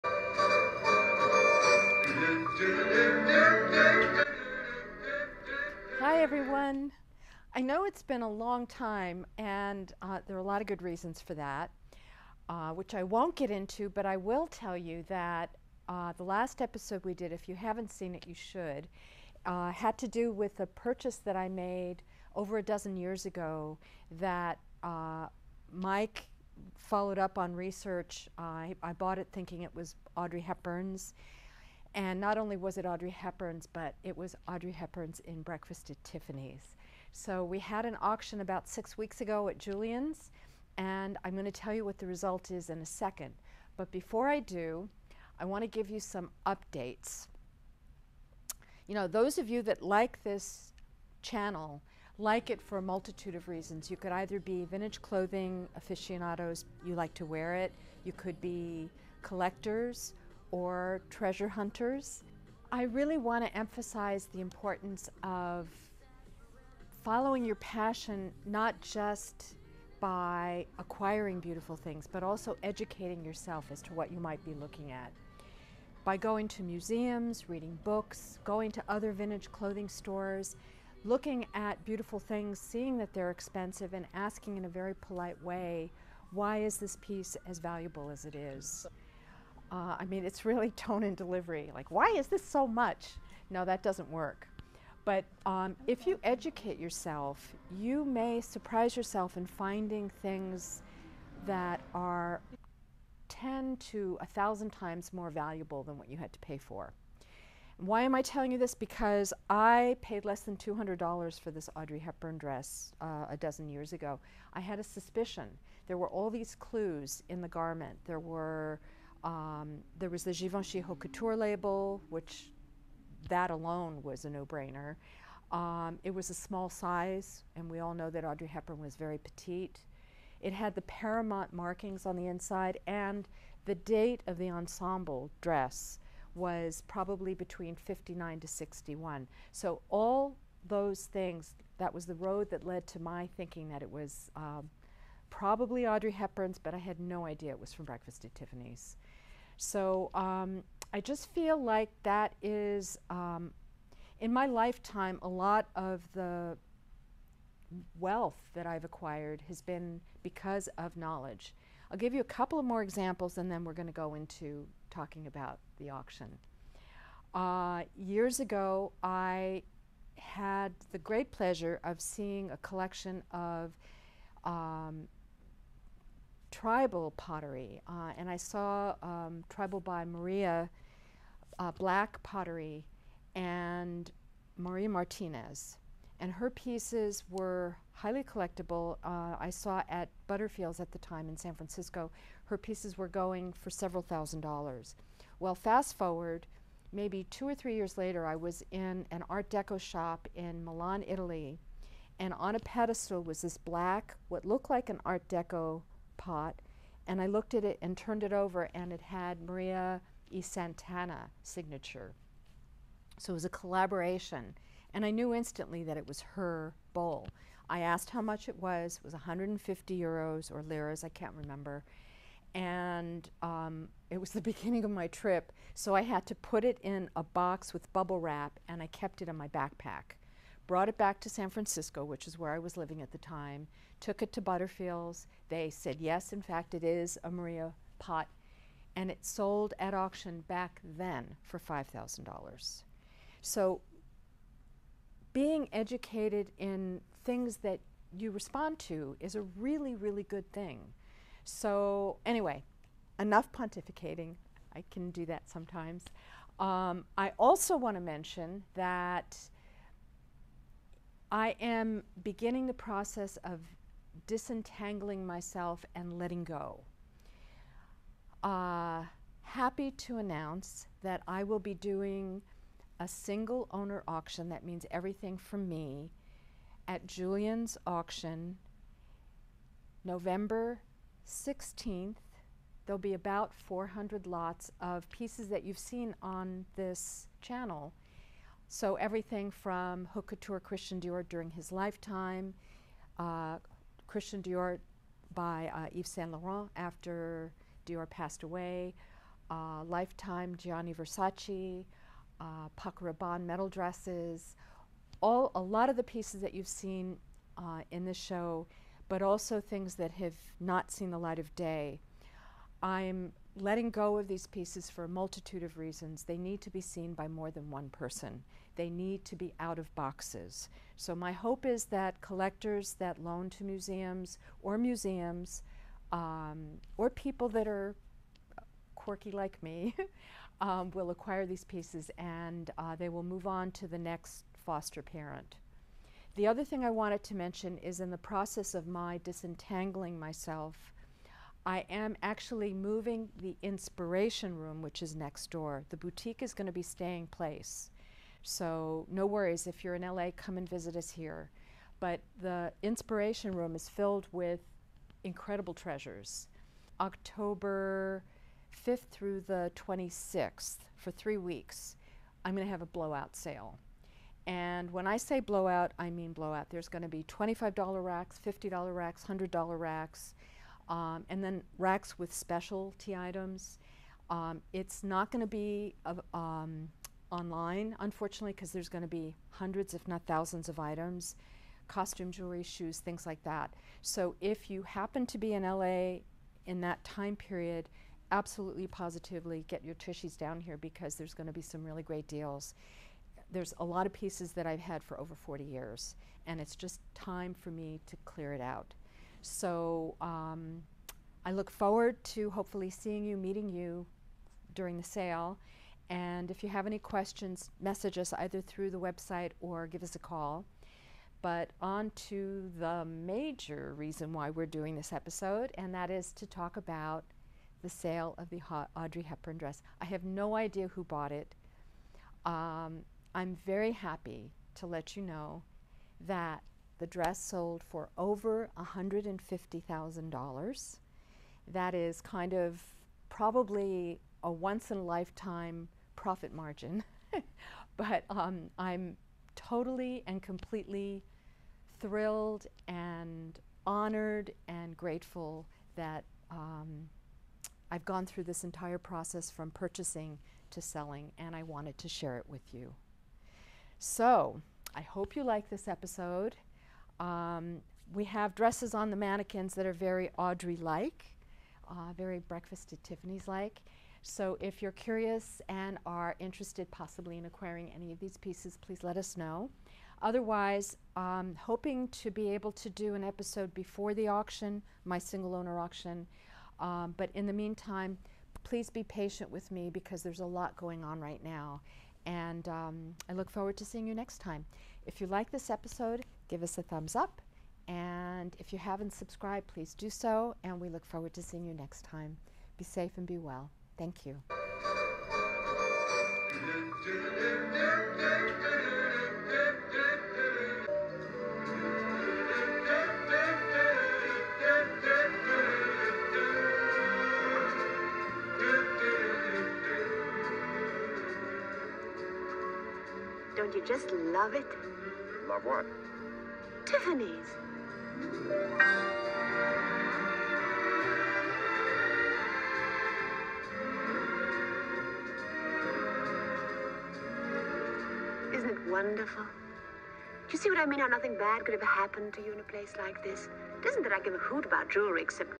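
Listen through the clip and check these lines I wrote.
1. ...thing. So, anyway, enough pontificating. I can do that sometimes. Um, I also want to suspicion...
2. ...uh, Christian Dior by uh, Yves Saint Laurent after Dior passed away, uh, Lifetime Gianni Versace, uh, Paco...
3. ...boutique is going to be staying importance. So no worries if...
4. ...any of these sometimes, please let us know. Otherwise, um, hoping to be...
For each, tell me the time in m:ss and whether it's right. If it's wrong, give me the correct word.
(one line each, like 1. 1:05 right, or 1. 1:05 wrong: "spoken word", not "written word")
1. 4:10 wrong: "mention", not "suspicion"
2. 4:53 right
3. 5:45 wrong: "place", not "importance"
4. 7:47 wrong: "pieces", not "sometimes".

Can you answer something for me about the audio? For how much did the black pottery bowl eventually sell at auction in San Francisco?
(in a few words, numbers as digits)
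$5,000.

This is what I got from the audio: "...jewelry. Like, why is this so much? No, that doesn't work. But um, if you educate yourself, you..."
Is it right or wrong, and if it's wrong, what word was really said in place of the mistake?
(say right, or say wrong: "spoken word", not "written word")
wrong: "delivery", not "jewelry".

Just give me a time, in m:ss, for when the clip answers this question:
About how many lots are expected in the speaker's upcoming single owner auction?
4:43.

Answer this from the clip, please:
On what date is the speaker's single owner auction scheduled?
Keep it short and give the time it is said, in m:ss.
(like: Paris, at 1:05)
November 16th, at 4:40.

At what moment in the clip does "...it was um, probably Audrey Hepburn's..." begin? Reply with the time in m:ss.
2:23.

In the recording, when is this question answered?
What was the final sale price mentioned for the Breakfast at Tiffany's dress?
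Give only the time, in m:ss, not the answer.
7:08.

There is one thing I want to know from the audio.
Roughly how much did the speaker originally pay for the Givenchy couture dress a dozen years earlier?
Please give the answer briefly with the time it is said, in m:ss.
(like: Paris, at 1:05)
less than $200, at 1:50.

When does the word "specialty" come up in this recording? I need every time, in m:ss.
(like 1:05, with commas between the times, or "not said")
6:12.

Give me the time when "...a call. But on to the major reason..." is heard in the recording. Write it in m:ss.
6:50.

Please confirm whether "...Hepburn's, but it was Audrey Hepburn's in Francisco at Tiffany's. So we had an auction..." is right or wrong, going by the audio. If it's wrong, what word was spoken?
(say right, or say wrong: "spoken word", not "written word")
wrong: "Breakfast", not "Francisco".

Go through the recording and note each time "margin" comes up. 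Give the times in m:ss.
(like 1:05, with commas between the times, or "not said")
7:16.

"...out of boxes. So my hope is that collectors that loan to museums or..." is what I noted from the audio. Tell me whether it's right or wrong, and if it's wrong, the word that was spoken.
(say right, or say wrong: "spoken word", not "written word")
right.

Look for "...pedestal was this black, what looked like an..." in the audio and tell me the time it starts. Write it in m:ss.
3:22.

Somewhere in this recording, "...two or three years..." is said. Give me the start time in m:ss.
3:17.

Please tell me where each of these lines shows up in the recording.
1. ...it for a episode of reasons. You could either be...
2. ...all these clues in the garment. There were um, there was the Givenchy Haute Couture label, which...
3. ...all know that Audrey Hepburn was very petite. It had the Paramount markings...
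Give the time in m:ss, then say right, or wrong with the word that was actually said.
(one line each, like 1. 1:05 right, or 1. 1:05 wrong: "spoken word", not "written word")
1. 0:52 wrong: "multitude", not "episode"
2. 1:56 right
3. 2:07 right.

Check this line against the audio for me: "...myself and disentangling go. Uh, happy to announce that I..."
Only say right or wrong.
wrong.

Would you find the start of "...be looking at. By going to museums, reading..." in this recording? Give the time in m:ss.
1:14.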